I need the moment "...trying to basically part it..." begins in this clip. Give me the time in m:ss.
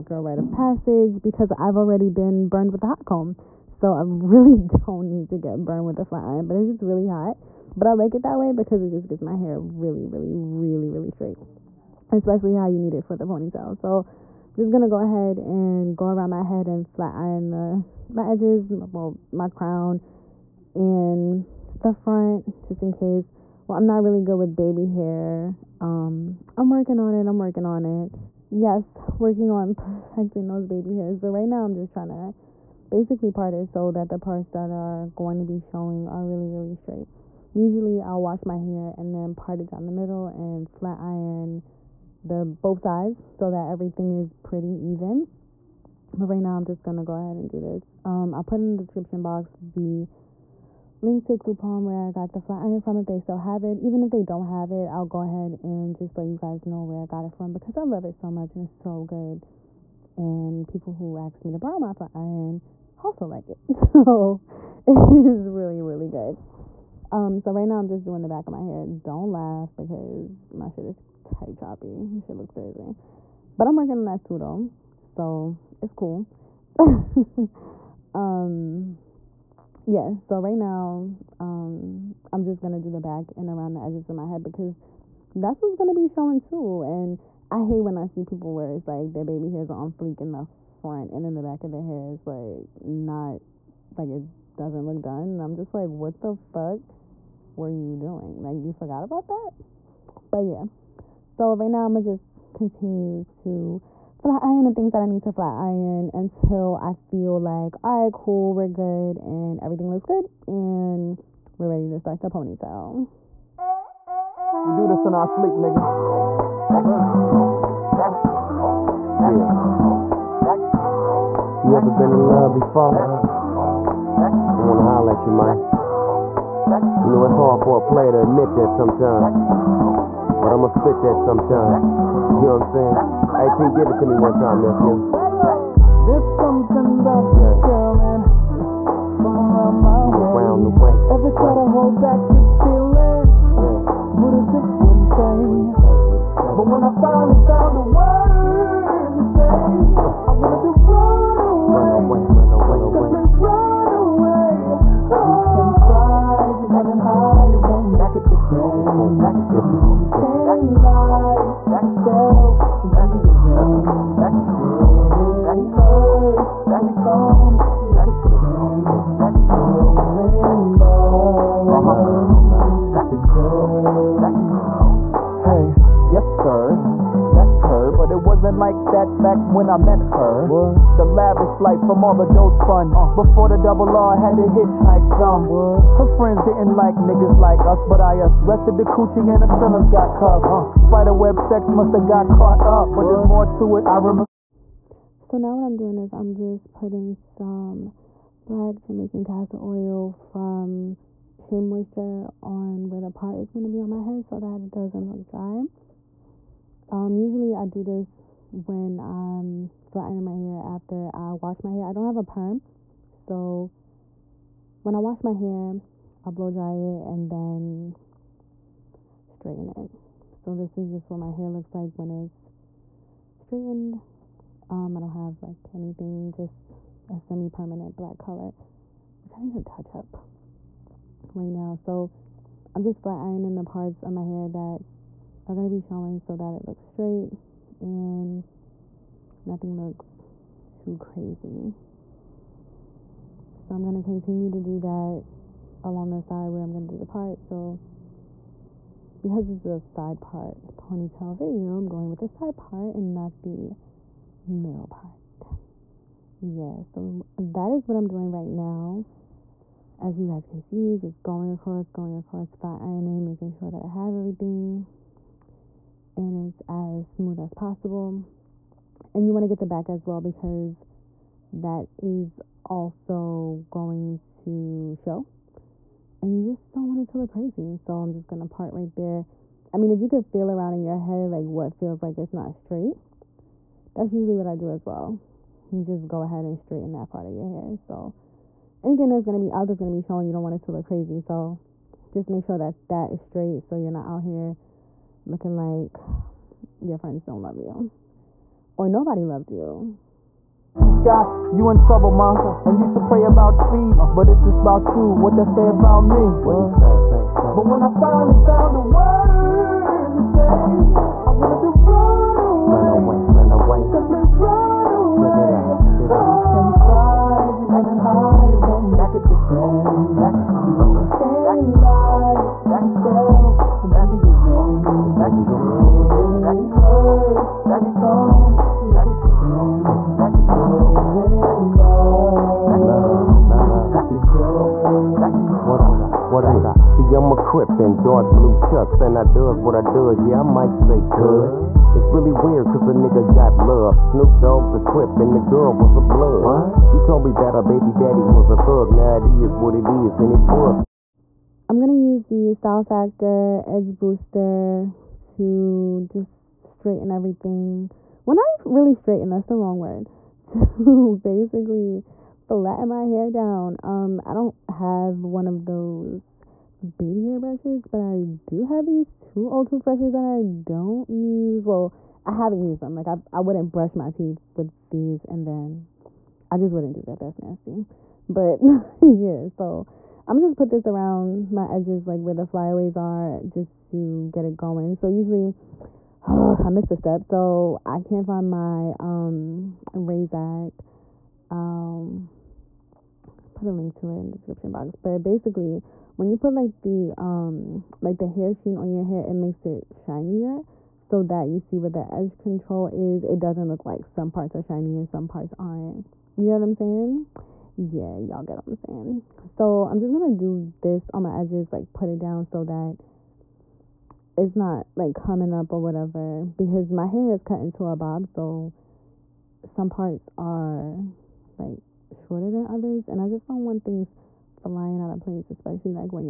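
0:31.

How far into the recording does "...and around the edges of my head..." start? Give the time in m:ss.
1:23.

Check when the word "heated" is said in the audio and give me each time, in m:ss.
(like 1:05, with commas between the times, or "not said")
not said.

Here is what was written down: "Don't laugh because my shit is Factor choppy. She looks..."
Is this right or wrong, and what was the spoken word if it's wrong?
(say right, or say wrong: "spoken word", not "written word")
wrong: "Type", not "Factor".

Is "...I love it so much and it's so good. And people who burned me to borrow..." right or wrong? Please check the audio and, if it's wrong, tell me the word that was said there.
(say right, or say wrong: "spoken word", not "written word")
wrong: "asked", not "burned".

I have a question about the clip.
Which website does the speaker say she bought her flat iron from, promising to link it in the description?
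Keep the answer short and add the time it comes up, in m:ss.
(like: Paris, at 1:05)
Groupon, at 0:51.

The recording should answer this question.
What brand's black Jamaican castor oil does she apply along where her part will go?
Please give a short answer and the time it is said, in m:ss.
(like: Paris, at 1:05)
Shea Moisture, at 3:21.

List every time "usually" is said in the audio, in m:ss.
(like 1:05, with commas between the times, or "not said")
0:37, 3:27, 4:44, 6:25.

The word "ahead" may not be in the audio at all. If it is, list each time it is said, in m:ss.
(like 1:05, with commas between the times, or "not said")
0:14, 0:47, 0:55, 4:46.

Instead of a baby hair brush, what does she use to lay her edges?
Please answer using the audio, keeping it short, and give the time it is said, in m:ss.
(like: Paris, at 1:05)
Old toothbrushes, at 6:09.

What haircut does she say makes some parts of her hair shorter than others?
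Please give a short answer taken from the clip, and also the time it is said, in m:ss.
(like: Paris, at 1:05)
Bob, at 6:57.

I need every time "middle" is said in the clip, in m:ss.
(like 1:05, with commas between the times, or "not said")
0:39, 4:14.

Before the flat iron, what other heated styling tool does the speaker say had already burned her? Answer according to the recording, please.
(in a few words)
Hot comb.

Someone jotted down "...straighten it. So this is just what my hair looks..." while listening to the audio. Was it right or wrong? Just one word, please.
right.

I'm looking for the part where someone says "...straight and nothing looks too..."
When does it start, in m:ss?
3:56.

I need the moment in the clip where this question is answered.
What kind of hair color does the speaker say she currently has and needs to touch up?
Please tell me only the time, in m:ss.
3:47.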